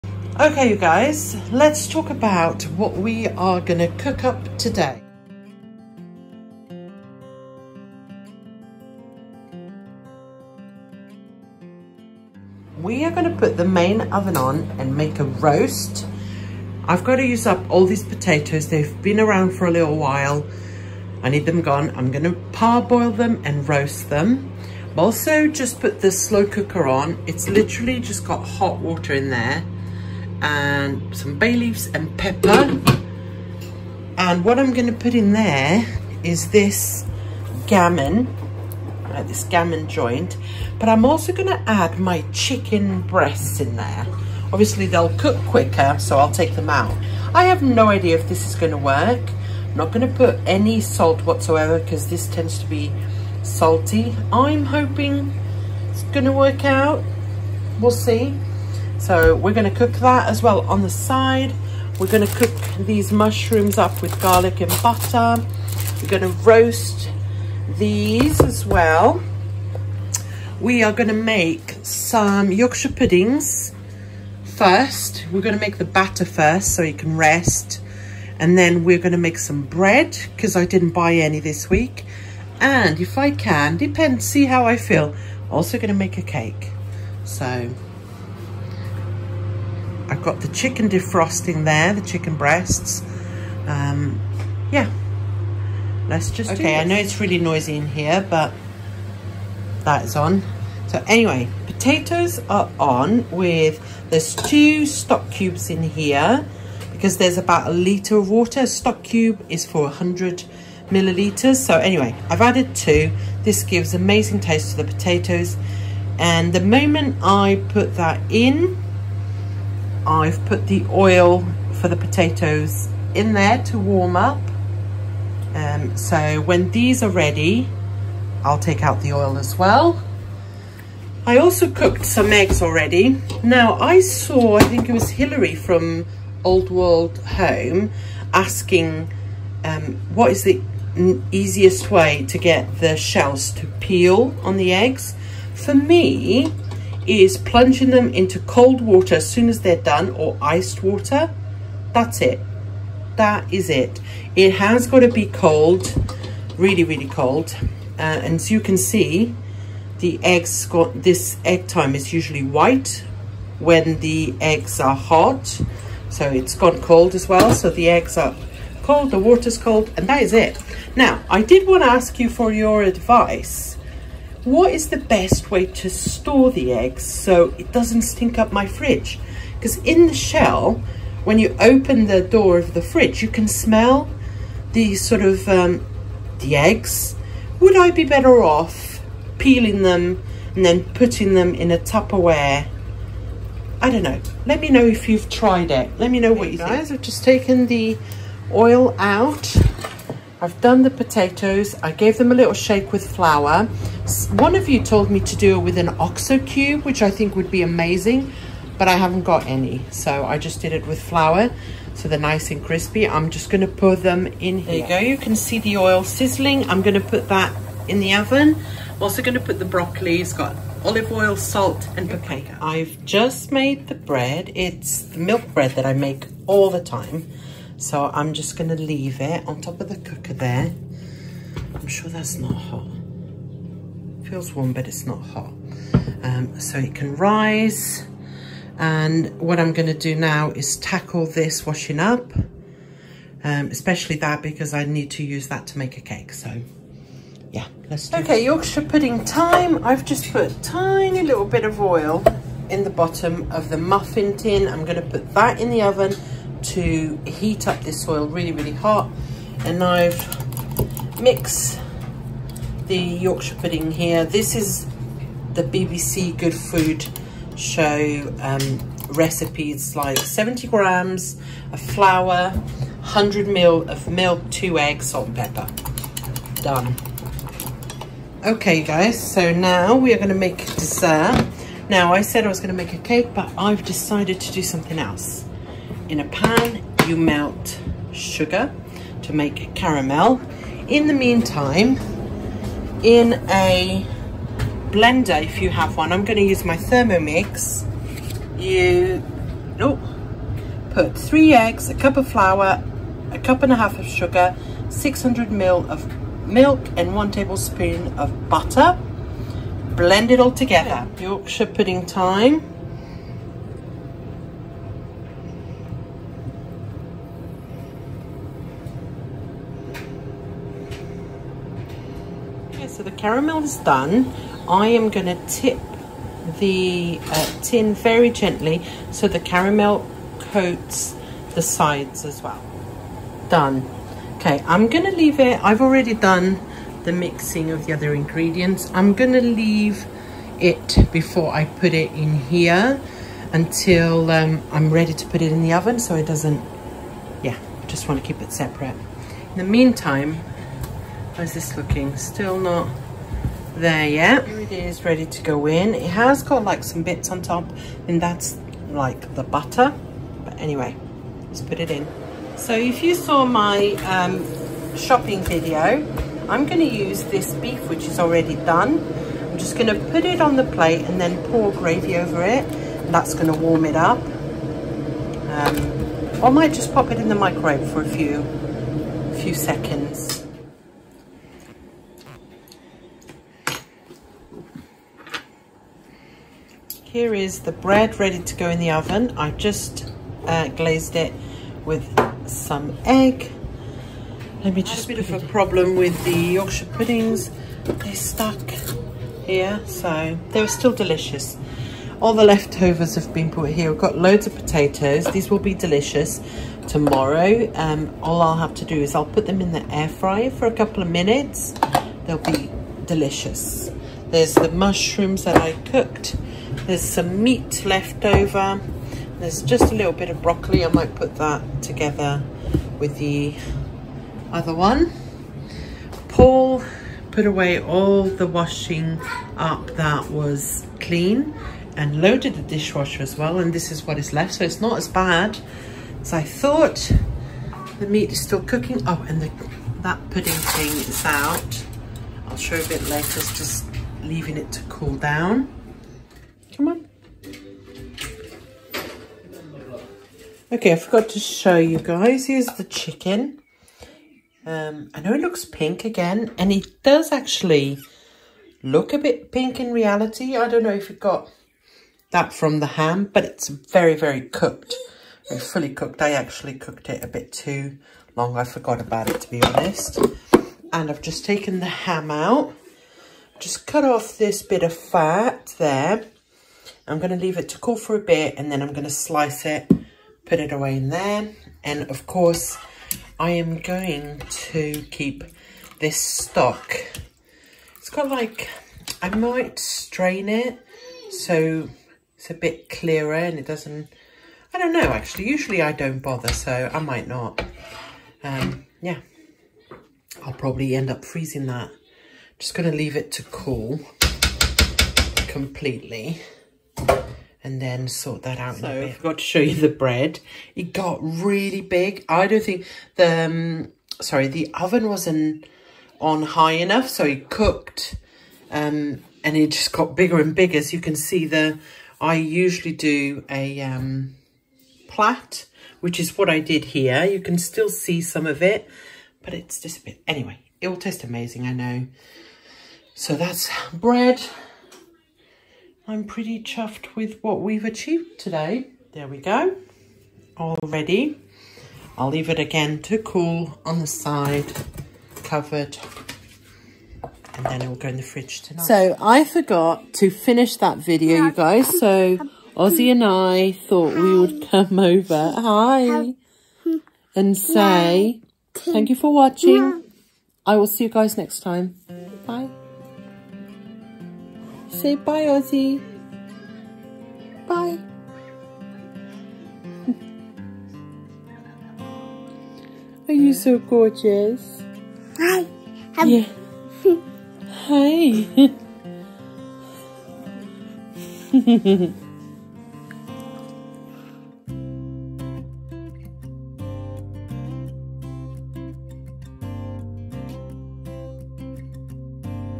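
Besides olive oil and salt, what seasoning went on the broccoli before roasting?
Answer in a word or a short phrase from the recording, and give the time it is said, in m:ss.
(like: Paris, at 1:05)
paprika, at 3:42.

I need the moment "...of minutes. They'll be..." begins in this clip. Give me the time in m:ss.
6:51.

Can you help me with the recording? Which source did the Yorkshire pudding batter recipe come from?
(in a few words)
BBC Good Food Show.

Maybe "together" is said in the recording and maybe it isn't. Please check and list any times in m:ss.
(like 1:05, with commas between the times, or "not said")
5:10, 7:01.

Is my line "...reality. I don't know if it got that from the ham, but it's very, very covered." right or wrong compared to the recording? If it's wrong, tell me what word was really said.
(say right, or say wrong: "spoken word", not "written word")
wrong: "cooked", not "covered".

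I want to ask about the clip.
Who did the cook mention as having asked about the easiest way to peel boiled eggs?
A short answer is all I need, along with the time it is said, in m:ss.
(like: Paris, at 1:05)
Hillary, at 2:15.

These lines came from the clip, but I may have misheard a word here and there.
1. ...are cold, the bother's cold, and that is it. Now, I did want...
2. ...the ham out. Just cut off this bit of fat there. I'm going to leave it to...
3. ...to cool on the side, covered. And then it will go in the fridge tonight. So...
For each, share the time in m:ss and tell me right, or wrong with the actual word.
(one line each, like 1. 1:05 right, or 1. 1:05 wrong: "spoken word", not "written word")
1. 2:48 wrong: "water", not "bother"
2. 7:51 right
3. 9:03 right.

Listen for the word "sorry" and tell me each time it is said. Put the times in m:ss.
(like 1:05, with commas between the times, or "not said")
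8:34.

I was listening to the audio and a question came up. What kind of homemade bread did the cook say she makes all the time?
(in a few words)
milk bread.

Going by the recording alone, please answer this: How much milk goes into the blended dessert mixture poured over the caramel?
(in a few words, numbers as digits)
600 ml.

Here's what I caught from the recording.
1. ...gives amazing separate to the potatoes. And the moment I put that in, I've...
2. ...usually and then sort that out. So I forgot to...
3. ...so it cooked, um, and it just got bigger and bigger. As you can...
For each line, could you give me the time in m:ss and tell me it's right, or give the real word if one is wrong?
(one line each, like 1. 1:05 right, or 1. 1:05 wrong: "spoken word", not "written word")
1. 1:53 wrong: "taste", not "separate"
2. 8:25 wrong: "completely", not "usually"
3. 8:37 right.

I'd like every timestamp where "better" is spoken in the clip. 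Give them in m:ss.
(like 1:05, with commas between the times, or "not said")
3:08.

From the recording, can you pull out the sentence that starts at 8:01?
And of course, I am going to keep this stock.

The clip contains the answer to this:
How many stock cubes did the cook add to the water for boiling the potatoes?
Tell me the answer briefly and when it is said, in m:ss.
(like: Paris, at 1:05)
2, at 1:44.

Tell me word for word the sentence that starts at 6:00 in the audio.
But anyway, let's put it in.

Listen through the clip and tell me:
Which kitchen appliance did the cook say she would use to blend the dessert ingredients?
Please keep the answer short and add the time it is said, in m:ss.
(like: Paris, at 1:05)
Thermomix, at 4:56.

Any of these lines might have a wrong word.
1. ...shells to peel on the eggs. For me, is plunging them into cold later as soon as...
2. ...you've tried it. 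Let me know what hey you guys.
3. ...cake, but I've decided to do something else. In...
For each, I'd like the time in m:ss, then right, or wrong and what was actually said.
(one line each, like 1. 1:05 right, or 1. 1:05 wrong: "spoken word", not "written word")
1. 2:22 wrong: "water", not "later"
2. 3:15 right
3. 4:42 right.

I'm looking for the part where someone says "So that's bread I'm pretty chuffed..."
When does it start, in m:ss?
8:53.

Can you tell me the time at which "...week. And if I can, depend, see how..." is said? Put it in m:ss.
1:21.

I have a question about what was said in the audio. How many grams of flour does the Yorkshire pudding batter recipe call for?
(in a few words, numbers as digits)
70 grams.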